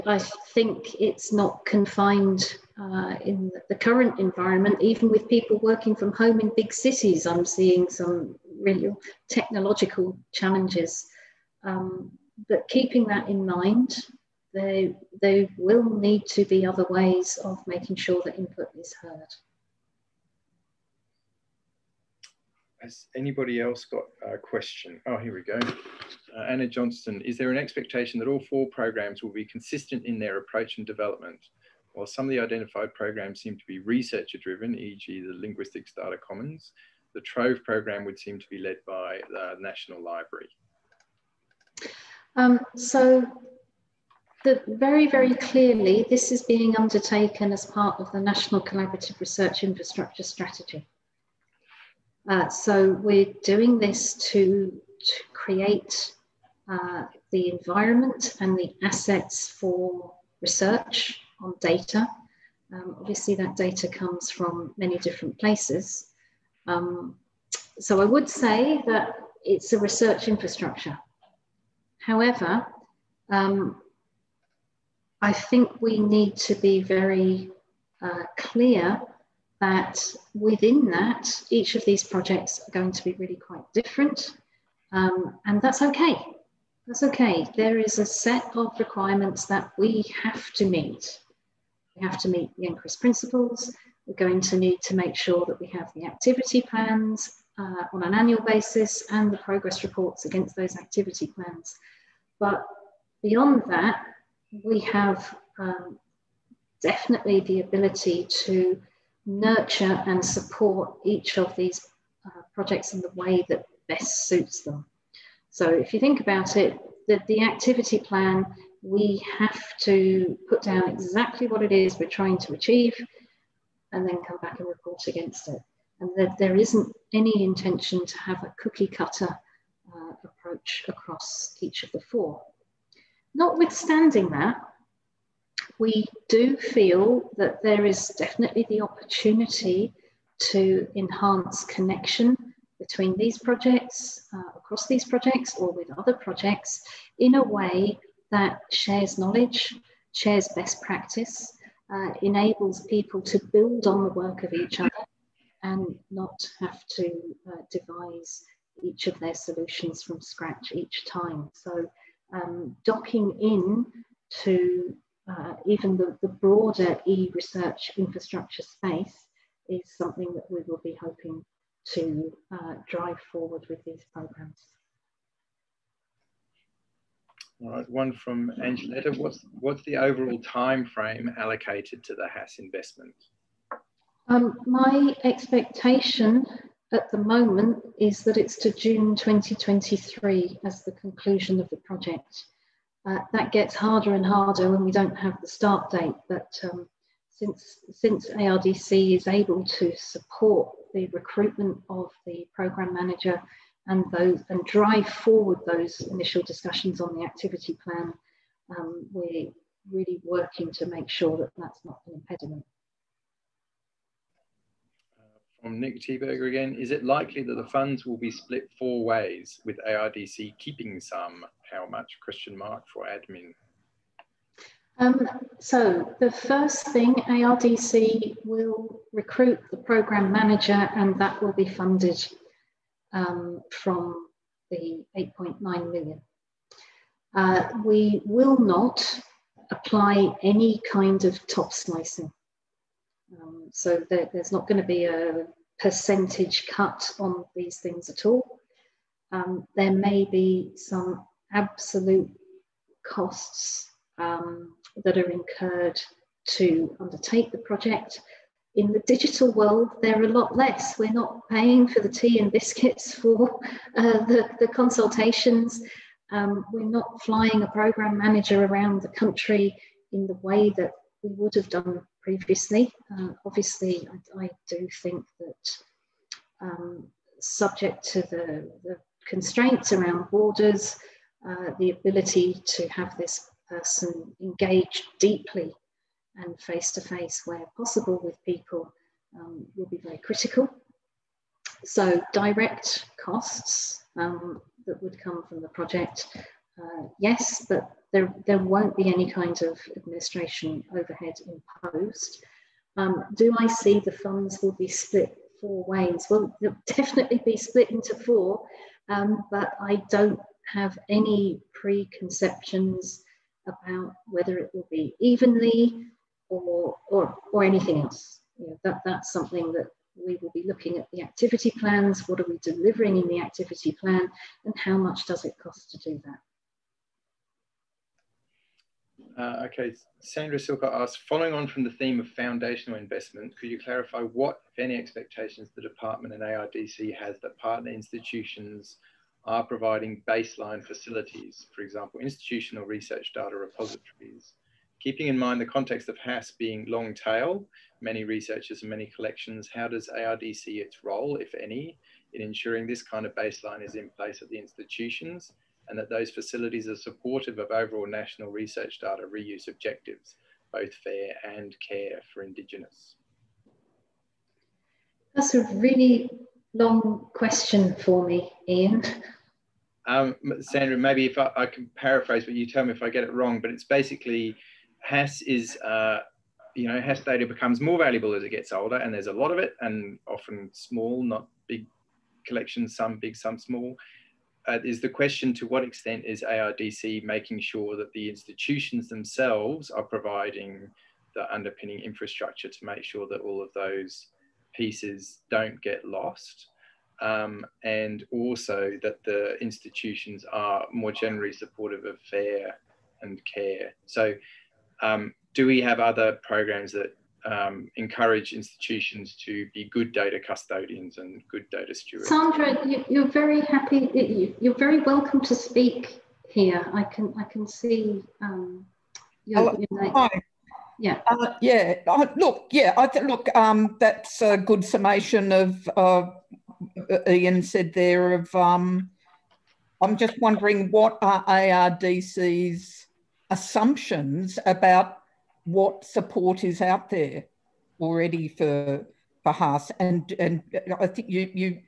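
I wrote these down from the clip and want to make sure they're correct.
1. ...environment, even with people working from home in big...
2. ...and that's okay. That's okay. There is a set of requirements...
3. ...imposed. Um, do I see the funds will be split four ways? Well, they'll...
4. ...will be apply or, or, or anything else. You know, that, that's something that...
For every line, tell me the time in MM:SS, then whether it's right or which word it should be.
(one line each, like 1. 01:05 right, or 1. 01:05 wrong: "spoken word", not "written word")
1. 00:04 right
2. 01:25 right
3. 05:01 right
4. 05:14 wrong: "evenly", not "apply".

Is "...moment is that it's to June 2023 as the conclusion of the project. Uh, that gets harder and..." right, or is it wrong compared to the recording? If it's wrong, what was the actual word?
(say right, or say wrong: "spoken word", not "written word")
right.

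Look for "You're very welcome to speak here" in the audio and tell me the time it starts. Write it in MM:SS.
06:54.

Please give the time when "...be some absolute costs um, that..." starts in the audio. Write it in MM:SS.
04:10.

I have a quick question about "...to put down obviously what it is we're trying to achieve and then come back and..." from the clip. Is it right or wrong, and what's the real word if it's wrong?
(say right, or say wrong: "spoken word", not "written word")
wrong: "exactly", not "obviously".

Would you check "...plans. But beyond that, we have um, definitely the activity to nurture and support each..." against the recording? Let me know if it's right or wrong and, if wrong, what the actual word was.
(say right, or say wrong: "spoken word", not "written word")
wrong: "ability", not "activity".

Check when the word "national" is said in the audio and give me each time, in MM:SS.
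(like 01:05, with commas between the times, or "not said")
00:39, 00:48, 05:58.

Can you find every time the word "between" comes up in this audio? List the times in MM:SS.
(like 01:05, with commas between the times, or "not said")
02:22.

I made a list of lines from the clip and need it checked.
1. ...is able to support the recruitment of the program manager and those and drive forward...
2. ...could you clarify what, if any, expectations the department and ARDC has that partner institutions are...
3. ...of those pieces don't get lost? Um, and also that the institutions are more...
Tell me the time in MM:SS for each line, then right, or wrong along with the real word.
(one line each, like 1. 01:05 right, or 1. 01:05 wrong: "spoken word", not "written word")
1. 03:19 right
2. 05:33 right
3. 06:33 right.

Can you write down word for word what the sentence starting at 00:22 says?
Has anybody else got a question?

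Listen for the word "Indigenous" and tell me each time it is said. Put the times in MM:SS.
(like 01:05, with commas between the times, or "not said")
06:02.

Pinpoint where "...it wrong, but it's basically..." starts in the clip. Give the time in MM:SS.
06:13.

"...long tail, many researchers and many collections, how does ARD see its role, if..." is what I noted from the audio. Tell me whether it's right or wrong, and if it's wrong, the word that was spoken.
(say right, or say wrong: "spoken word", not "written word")
right.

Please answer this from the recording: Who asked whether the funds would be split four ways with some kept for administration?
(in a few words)
Nick Thieberger.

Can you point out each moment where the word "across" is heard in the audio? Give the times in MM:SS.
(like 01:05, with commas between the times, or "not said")
02:10, 02:24.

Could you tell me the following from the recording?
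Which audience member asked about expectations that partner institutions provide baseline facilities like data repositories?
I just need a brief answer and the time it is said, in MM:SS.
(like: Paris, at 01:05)
Sandra Silka, at 05:30.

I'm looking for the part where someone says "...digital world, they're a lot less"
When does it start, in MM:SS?
04:19.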